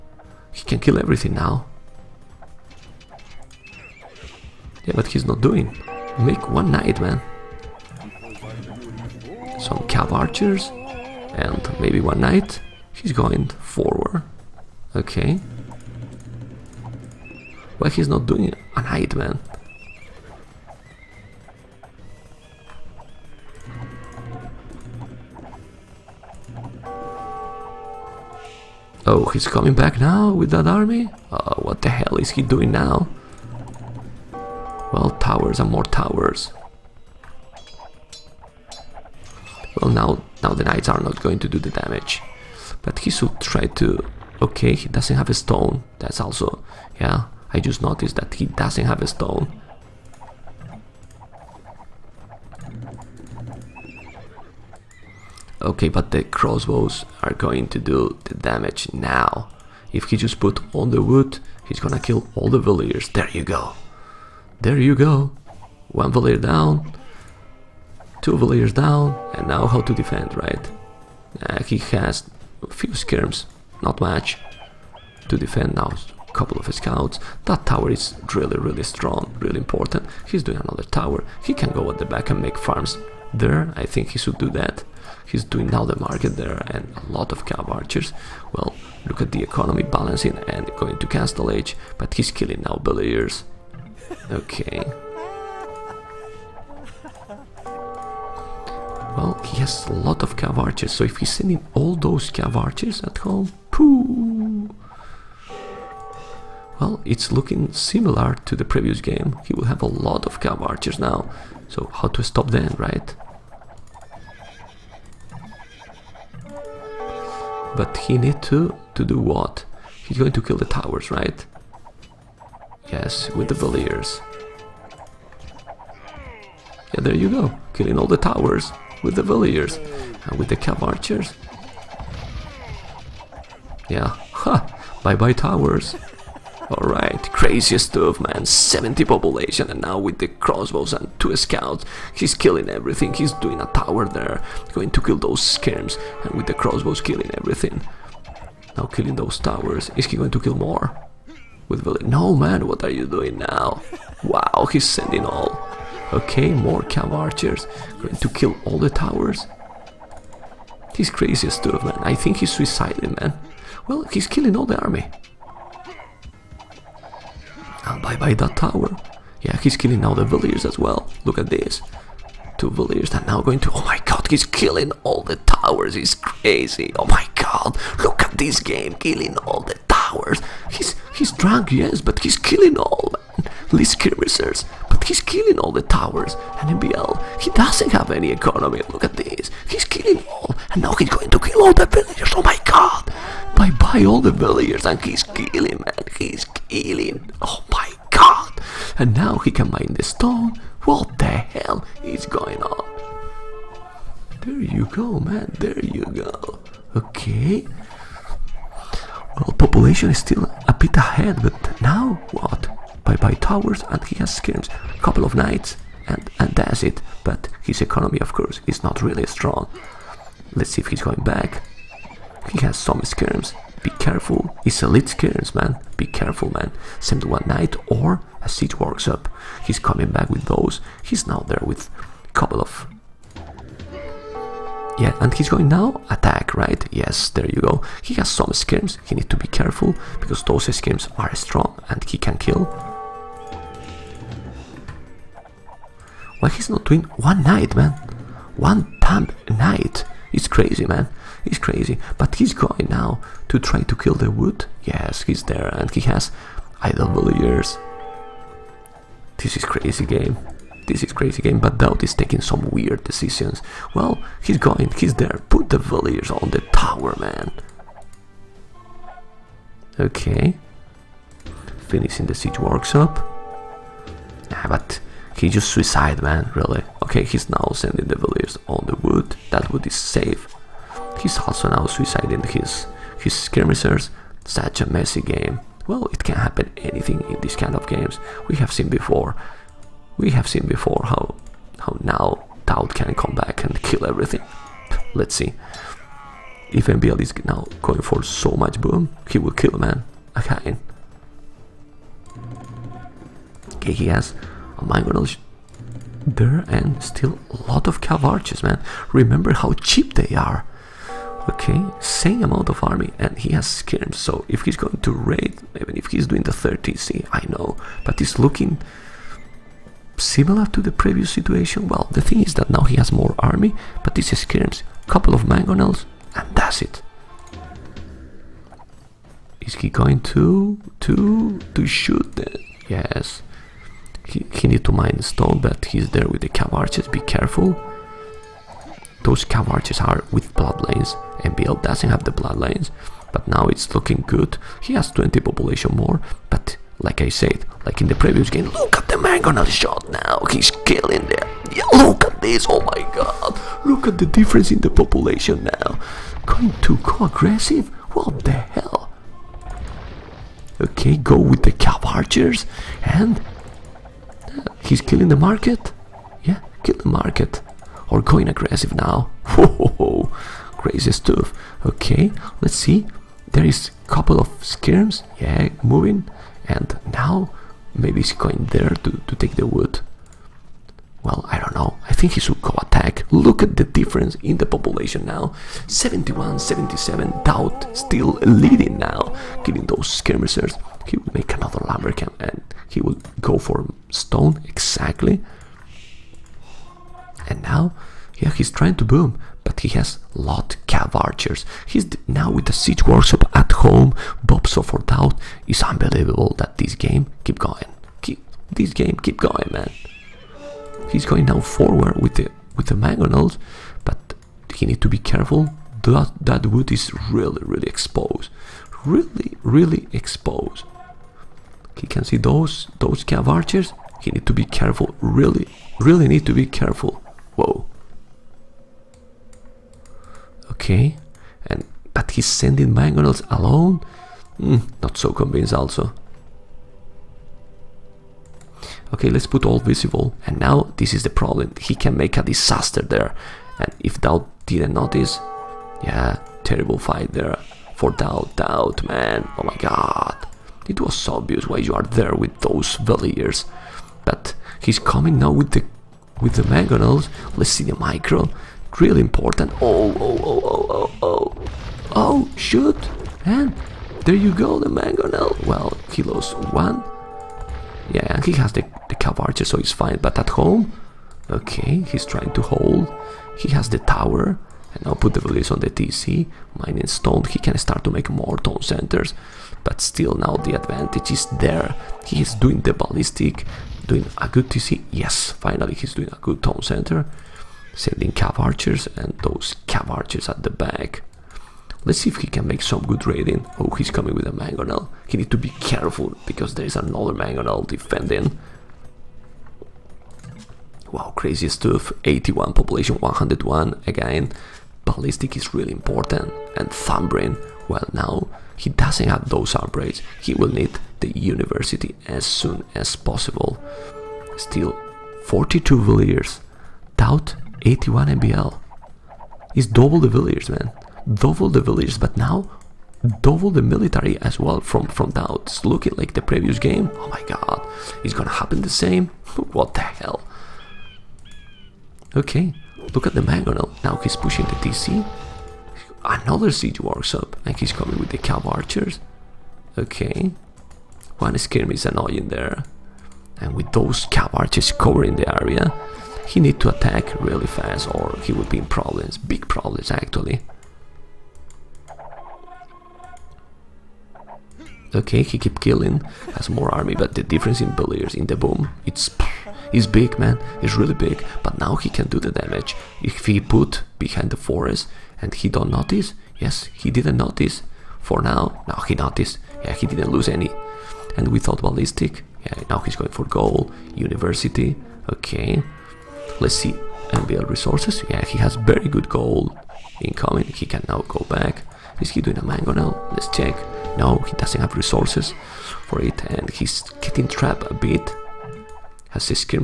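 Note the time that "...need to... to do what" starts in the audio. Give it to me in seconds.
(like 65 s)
118 s.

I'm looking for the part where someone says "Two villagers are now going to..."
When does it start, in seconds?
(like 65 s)
172 s.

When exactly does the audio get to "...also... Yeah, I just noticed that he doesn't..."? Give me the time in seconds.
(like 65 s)
46 s.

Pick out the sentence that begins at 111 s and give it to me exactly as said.
So how to stop them, right?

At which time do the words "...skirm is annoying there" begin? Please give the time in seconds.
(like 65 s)
541 s.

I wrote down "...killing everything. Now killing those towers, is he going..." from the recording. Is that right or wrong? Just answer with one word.
right.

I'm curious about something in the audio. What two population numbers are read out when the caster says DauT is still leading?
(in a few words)
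71 and 77.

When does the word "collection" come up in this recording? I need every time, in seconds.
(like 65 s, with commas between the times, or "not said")
not said.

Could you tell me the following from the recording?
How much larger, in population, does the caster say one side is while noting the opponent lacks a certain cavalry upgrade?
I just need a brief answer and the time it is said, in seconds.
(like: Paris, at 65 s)
20, at 345 s.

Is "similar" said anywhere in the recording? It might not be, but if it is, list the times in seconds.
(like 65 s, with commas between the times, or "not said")
107 s, 320 s.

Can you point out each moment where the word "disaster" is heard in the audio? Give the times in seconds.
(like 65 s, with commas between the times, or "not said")
442 s.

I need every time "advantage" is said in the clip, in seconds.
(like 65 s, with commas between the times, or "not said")
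480 s.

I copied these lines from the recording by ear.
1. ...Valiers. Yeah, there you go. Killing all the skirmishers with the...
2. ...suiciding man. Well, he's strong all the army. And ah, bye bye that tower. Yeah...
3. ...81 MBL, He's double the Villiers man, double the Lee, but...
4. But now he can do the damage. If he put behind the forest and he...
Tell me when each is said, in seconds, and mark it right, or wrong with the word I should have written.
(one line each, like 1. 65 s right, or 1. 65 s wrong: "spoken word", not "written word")
1. 123 s wrong: "towers", not "skirmishers"
2. 162 s wrong: "killing", not "strong"
3. 517 s wrong: "Villiers", not "Lee"
4. 561 s right.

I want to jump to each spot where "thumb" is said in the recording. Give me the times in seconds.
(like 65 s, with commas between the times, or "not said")
507 s.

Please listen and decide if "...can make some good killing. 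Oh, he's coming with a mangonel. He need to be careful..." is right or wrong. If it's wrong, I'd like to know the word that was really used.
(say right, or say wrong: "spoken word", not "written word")
wrong: "raiding", not "killing".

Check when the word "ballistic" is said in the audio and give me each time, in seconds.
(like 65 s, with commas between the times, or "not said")
482 s, 505 s, 571 s.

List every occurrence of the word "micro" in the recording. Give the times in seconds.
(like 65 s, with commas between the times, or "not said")
457 s.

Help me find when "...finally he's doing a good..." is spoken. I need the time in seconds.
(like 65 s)
485 s.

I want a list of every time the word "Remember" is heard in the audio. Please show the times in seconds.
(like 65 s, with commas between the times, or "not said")
309 s.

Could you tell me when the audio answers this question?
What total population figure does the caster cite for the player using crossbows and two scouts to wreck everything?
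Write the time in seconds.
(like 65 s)
138 s.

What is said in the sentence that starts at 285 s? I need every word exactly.
Well, it can happen anything in these kind of games.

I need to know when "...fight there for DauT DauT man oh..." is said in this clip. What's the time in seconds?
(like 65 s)
446 s.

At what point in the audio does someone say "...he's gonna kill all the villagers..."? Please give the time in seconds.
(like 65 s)
61 s.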